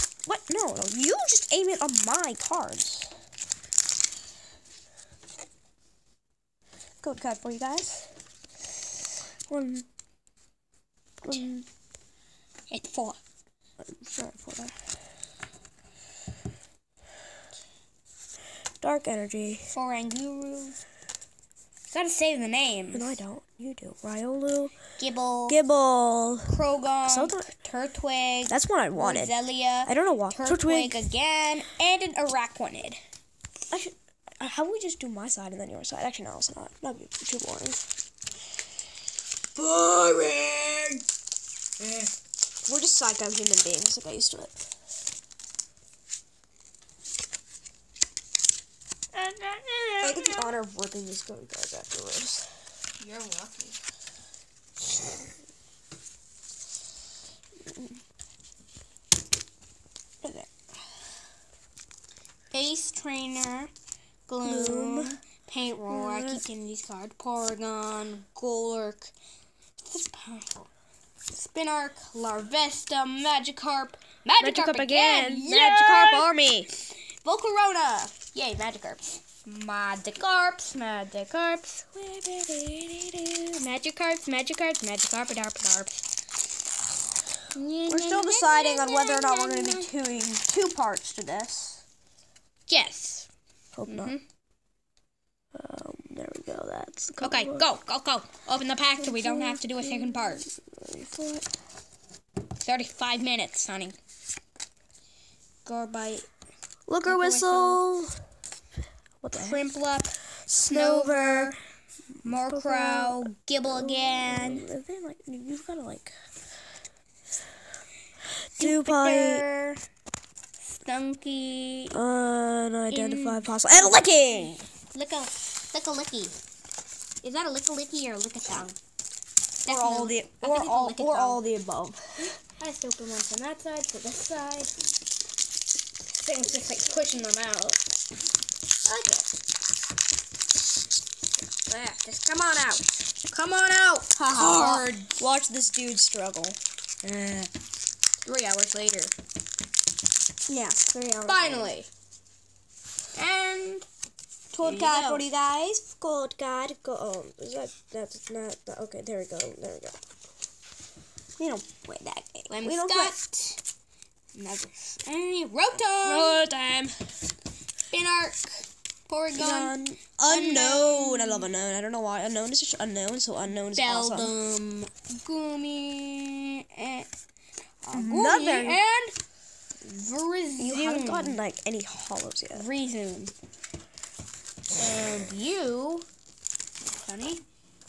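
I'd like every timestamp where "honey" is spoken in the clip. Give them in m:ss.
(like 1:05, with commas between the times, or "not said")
1:43, 3:07.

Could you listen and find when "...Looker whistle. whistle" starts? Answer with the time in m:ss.
1:47.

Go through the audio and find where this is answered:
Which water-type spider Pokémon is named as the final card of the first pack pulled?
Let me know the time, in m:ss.
0:32.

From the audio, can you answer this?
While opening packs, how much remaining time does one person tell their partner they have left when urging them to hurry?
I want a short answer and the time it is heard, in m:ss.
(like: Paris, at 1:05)
35 minutes, at 1:42.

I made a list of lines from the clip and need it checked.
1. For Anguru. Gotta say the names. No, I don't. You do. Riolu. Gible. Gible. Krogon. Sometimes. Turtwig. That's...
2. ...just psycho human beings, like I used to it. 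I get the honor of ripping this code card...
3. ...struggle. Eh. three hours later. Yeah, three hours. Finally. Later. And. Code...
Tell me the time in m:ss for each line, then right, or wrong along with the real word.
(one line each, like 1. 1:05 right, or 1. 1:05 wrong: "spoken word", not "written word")
1. 0:19 right
2. 0:42 right
3. 2:25 right.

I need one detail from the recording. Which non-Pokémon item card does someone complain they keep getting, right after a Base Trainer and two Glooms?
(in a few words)
Paint Roller.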